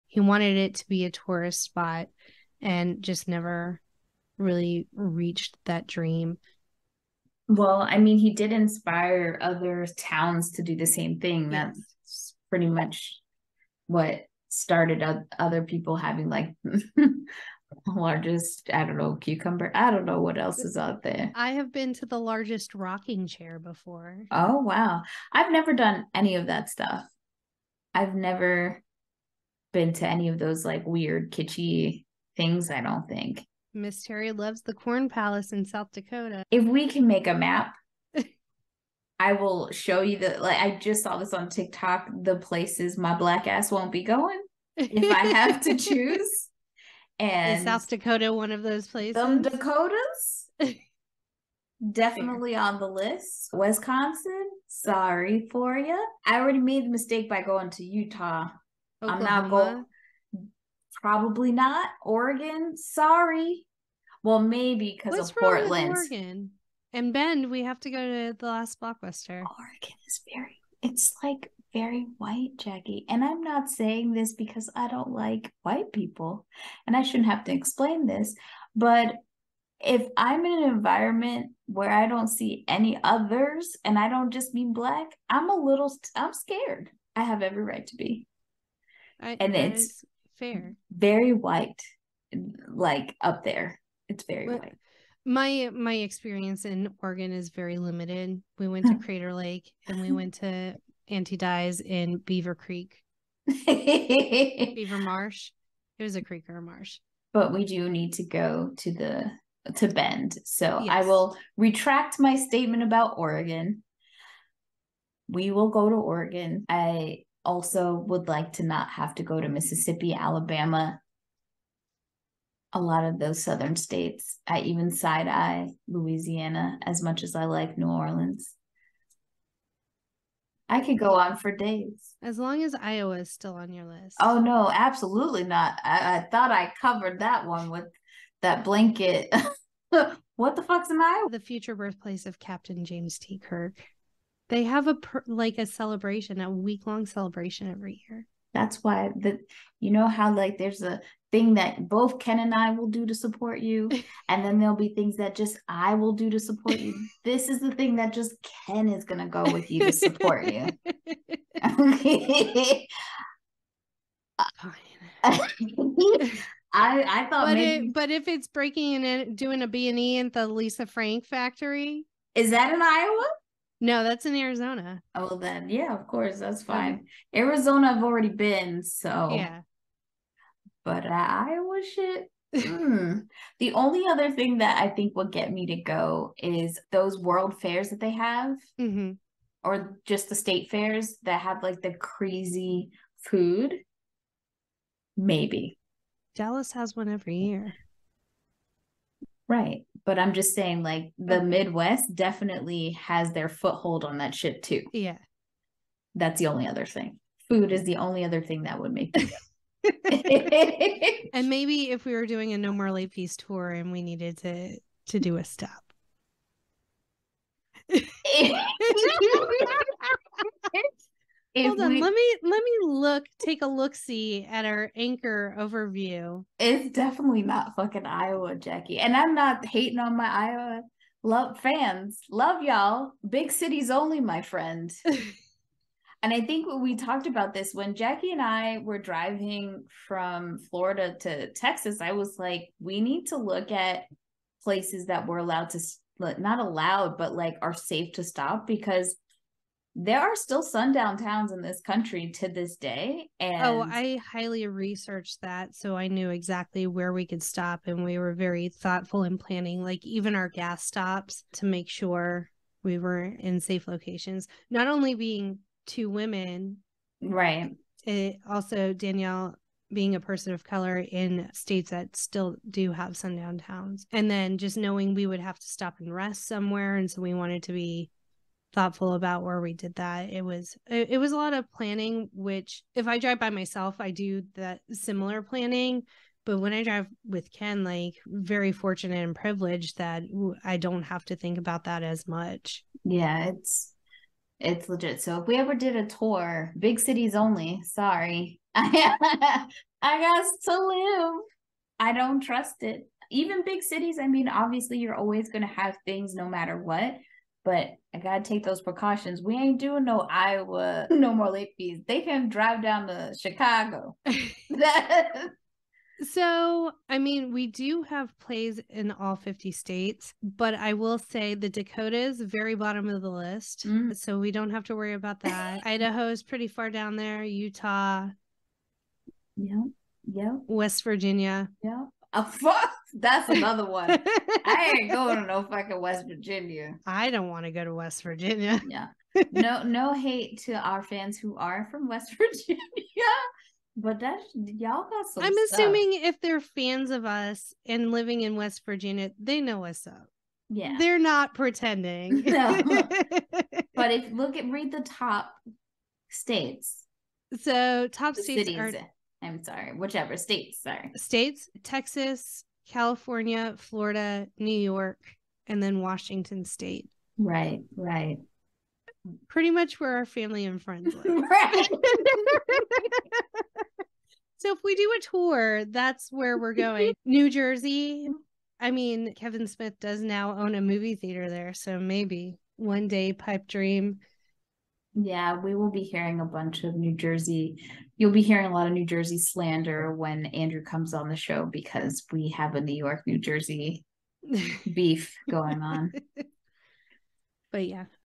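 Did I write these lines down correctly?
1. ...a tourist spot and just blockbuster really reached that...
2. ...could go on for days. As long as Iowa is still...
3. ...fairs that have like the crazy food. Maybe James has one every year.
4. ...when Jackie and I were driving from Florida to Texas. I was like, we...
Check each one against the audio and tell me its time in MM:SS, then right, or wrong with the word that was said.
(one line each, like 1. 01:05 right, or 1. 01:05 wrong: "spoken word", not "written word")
1. 00:01 wrong: "never", not "blockbuster"
2. 02:10 right
3. 03:10 wrong: "Dallas", not "James"
4. 03:57 right.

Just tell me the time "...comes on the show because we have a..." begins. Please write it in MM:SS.
06:30.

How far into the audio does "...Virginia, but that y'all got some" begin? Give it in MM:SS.
05:42.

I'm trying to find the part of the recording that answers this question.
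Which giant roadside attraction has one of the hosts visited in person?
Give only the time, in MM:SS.
00:22.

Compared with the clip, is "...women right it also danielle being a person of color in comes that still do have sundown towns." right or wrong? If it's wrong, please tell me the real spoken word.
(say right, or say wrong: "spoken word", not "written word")
wrong: "states", not "comes".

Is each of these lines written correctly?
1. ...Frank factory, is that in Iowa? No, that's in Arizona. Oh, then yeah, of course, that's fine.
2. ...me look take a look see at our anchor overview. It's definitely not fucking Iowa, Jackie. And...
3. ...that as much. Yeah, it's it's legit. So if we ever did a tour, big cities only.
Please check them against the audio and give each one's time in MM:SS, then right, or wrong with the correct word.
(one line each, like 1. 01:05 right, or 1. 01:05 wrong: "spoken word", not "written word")
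1. 02:50 right
2. 03:42 right
3. 04:51 right.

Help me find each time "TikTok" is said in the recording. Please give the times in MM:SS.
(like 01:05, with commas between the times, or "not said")
00:41.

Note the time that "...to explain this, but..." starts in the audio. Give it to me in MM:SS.
01:17.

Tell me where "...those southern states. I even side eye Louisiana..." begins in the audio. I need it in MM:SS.
02:03.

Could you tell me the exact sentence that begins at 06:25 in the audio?
Yeah, we will be hearing a bunch of New Jersey.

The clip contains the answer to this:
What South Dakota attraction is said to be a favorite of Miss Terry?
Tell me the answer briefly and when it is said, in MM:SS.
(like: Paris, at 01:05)
Corn Palace, at 00:34.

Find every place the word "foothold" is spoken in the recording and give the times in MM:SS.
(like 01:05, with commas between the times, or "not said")
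03:23.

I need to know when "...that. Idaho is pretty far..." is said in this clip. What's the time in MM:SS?
05:25.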